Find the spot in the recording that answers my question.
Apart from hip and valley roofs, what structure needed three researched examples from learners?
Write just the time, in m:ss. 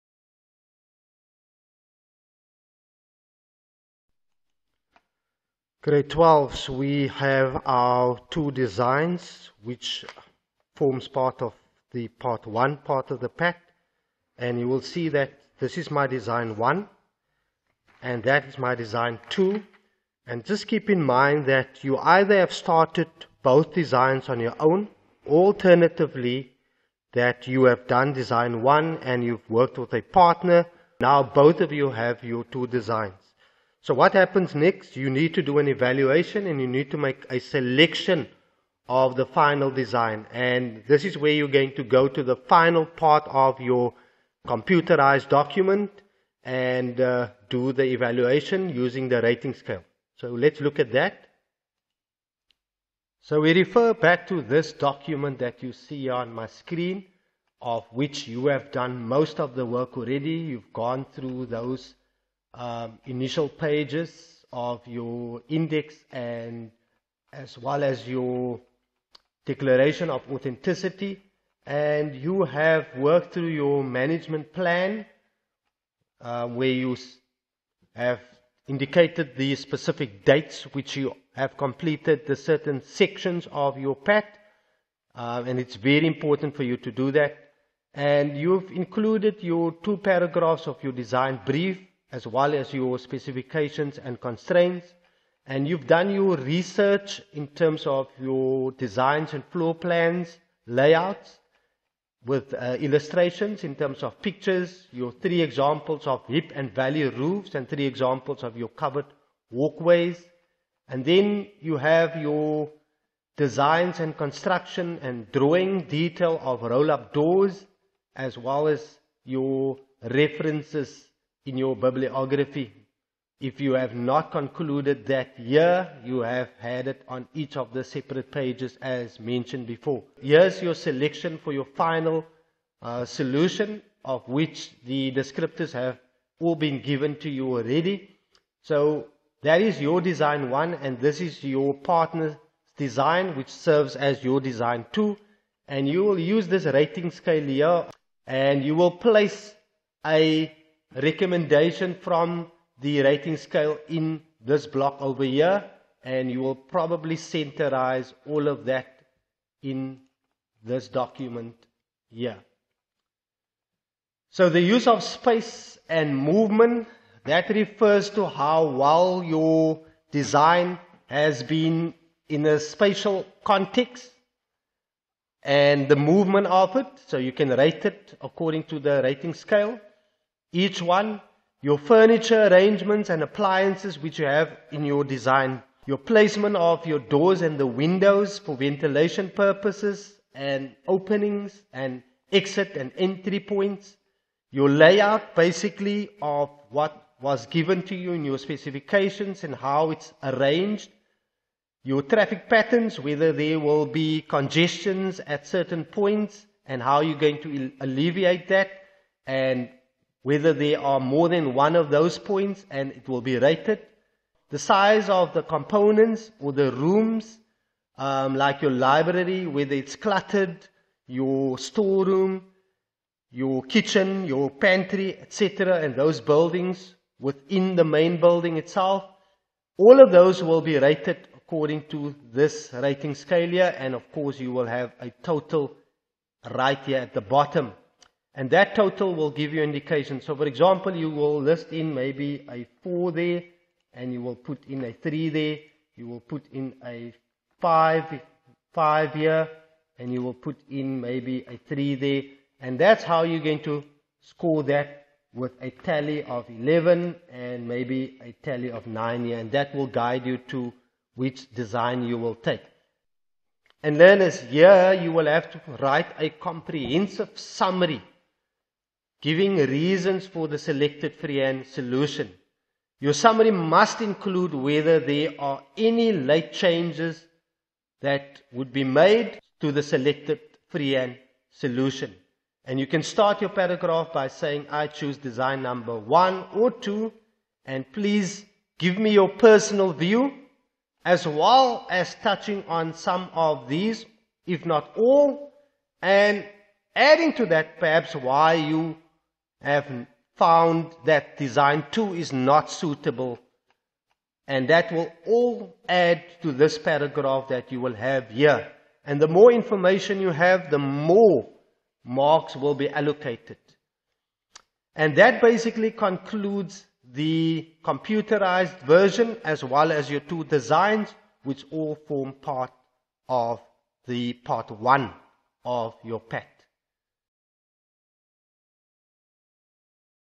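1:48.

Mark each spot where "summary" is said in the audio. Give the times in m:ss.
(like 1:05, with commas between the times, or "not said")
4:27, 4:33.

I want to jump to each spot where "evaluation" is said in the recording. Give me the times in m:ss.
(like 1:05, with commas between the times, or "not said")
0:35, 0:47.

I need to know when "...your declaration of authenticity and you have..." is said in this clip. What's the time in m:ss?
1:08.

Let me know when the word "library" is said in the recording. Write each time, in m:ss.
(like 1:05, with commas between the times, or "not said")
3:38.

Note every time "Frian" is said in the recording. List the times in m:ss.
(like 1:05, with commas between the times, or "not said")
4:31, 4:40.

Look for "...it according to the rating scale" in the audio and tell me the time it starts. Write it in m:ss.
2:57.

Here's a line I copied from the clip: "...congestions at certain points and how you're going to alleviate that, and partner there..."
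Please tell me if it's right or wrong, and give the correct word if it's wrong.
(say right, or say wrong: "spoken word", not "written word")
wrong: "whether", not "partner".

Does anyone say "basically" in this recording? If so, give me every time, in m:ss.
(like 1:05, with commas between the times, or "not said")
3:15, 5:15.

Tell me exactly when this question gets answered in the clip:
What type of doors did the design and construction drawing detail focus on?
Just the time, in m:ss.
1:56.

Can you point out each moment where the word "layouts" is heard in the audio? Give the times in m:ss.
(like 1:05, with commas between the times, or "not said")
1:40, 3:14.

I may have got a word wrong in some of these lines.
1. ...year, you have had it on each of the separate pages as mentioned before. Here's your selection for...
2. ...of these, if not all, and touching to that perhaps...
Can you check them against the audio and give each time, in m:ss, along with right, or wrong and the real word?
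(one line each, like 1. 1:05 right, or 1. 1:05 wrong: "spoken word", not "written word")
1. 2:05 right
2. 4:53 wrong: "adding", not "touching".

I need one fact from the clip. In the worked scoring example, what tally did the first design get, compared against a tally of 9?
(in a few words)
11.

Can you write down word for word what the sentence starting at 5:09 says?
And the more information you have, the more marks will be allocated.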